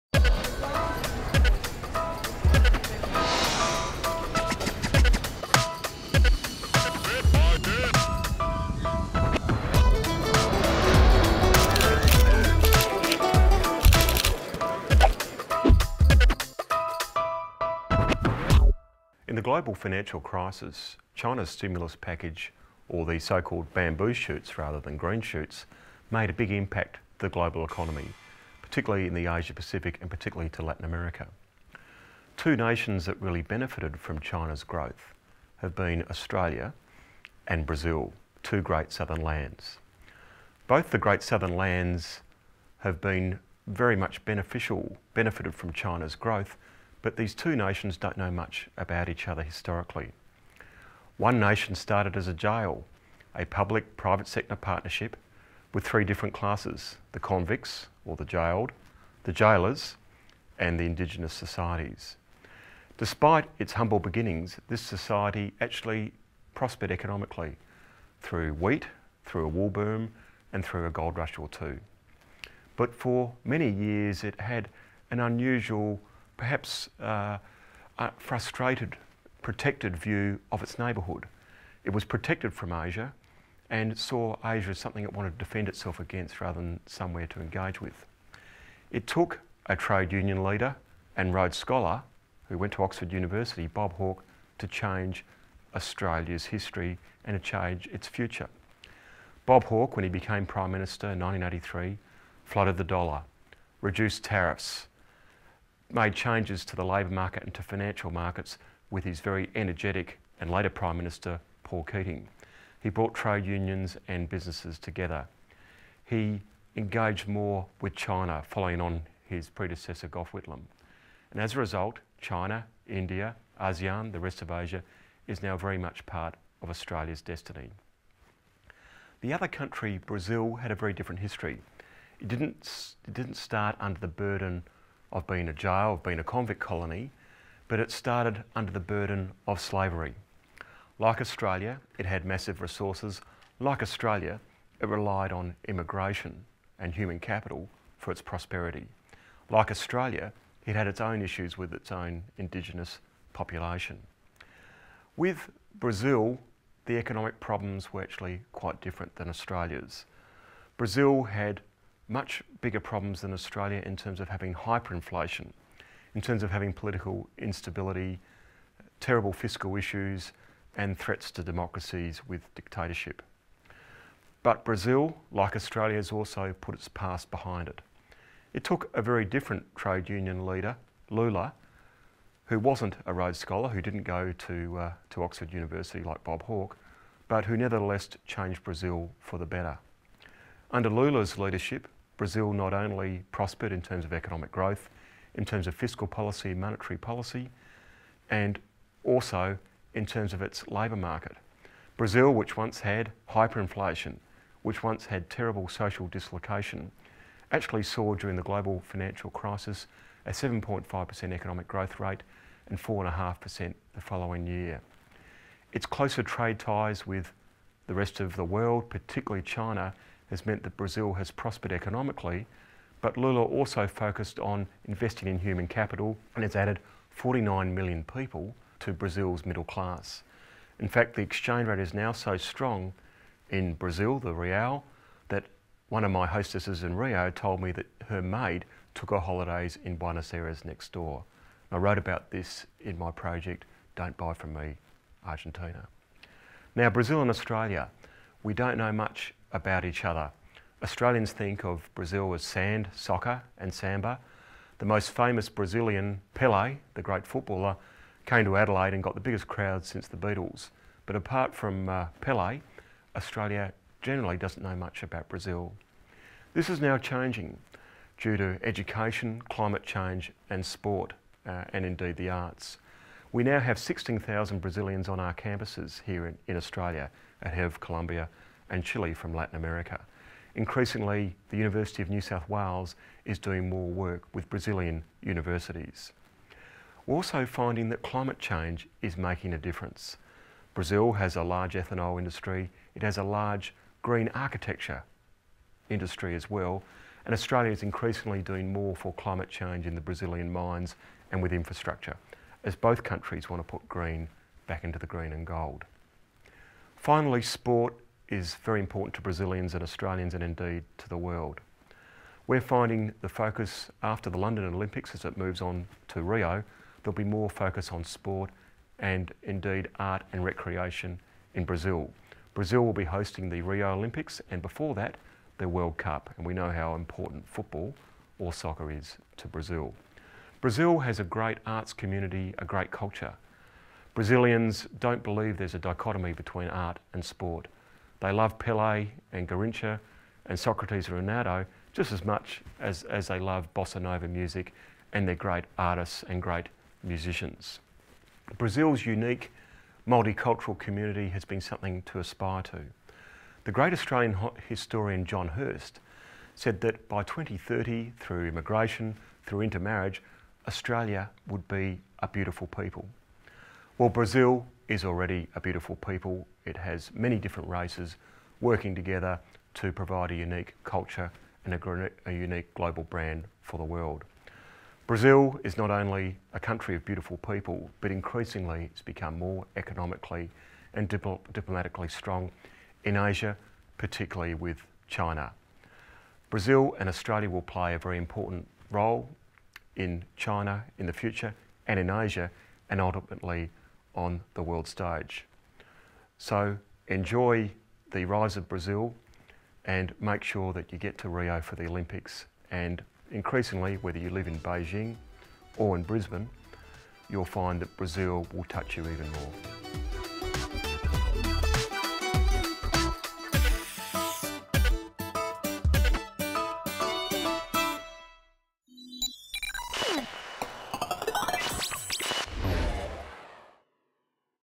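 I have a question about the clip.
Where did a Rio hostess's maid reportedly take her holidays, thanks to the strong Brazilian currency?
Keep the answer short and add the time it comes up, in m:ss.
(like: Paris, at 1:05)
Buenos Aires, at 3:59.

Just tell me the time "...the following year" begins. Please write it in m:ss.
3:33.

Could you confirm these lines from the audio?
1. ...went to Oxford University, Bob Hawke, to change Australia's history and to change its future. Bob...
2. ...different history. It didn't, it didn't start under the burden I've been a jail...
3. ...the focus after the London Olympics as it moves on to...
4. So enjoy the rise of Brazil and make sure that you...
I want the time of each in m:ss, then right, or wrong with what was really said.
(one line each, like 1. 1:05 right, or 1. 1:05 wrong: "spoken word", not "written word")
1. 1:32 right
2. 2:10 right
3. 5:13 right
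4. 6:36 right.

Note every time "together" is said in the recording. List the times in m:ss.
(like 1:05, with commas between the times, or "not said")
1:54, 6:08.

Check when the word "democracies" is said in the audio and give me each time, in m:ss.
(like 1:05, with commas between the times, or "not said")
2:51.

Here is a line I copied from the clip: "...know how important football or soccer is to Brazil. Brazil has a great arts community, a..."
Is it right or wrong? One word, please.
right.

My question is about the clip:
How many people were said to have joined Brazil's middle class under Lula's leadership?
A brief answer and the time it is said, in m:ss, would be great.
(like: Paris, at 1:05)
49 million, at 3:47.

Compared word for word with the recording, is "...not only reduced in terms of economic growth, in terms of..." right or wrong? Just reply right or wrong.
wrong.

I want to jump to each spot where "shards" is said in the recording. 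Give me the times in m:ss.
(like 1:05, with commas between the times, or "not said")
not said.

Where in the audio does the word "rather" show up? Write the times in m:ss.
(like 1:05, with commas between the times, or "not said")
0:24, 1:26.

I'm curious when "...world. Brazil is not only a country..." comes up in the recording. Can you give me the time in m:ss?
6:13.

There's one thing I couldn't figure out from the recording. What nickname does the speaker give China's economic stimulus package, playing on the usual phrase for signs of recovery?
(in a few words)
bamboo shoots.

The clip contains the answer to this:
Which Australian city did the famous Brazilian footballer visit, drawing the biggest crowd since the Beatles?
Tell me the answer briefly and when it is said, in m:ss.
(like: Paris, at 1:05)
Adelaide, at 4:18.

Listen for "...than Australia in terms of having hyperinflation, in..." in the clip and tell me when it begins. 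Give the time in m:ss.
2:43.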